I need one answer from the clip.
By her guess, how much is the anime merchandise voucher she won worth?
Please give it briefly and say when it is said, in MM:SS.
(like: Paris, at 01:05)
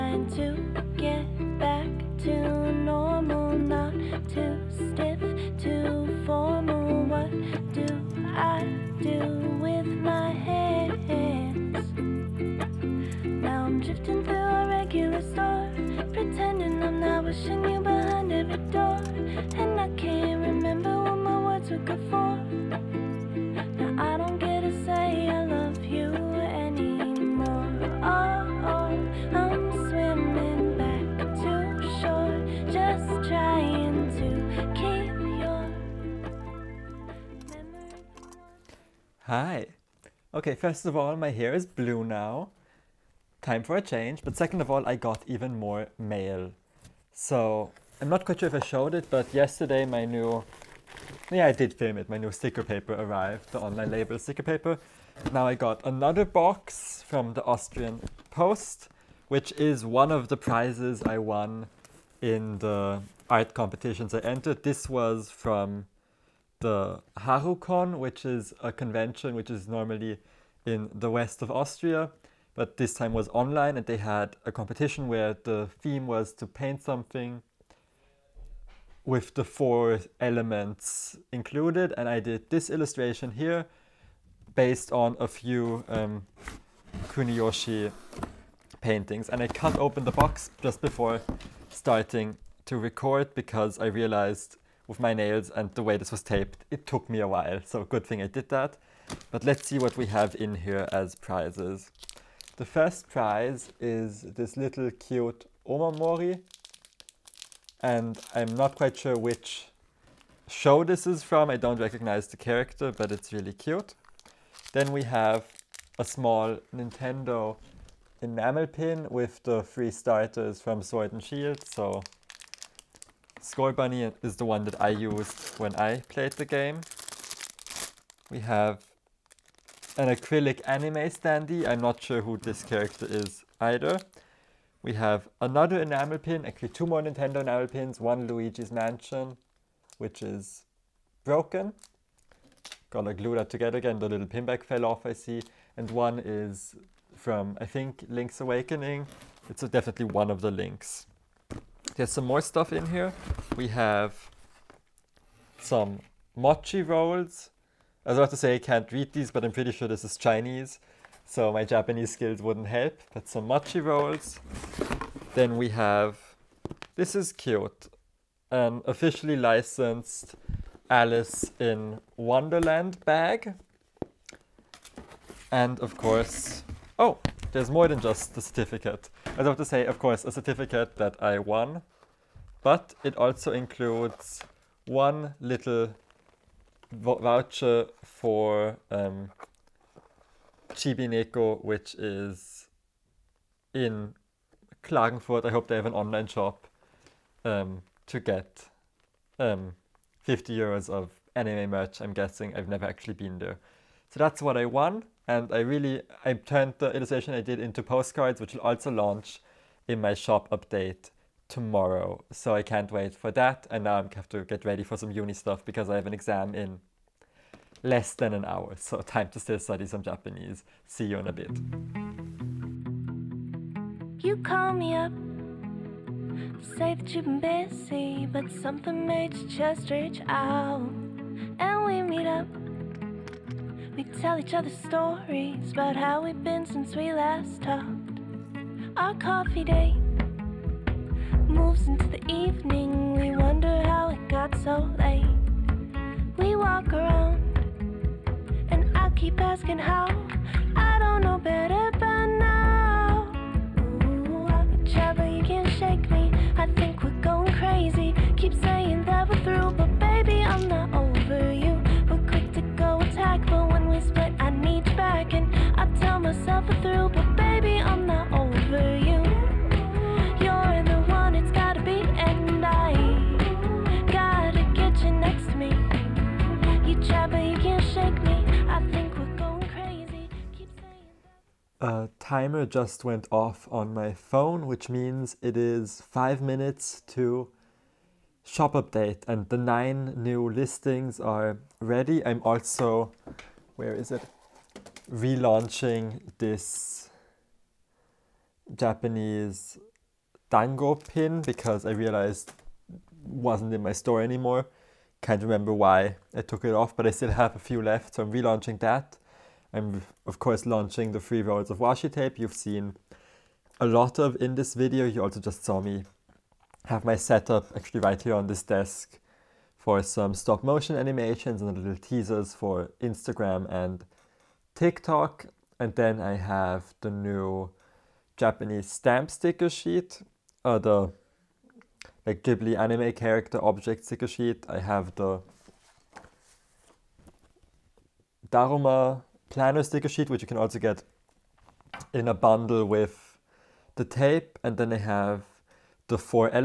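50 euros, at 03:20.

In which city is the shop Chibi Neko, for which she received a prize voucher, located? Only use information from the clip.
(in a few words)
Klagenfurt.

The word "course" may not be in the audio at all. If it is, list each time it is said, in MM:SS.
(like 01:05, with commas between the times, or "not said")
02:55, 02:59, 05:10.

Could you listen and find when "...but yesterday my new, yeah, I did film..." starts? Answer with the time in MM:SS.
00:49.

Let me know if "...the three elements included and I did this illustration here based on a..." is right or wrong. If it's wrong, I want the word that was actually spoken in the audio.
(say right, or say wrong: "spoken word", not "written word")
wrong: "four", not "three".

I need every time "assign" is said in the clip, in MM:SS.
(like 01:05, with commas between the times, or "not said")
not said.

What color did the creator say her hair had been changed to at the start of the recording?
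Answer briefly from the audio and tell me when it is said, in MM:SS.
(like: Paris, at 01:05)
blue, at 00:41.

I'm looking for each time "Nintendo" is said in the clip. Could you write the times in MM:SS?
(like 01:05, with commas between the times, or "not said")
01:56, 02:17.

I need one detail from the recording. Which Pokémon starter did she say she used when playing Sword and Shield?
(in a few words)
Scorbunny.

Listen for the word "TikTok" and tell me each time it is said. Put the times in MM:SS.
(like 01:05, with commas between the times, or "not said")
05:24.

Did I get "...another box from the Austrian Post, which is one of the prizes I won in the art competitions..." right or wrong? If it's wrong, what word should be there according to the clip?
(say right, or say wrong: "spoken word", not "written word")
right.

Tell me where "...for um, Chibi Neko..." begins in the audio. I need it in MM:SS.
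03:08.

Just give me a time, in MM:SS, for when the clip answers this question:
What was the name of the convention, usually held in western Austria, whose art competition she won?
01:07.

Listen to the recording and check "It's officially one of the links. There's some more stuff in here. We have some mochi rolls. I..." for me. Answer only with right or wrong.
wrong.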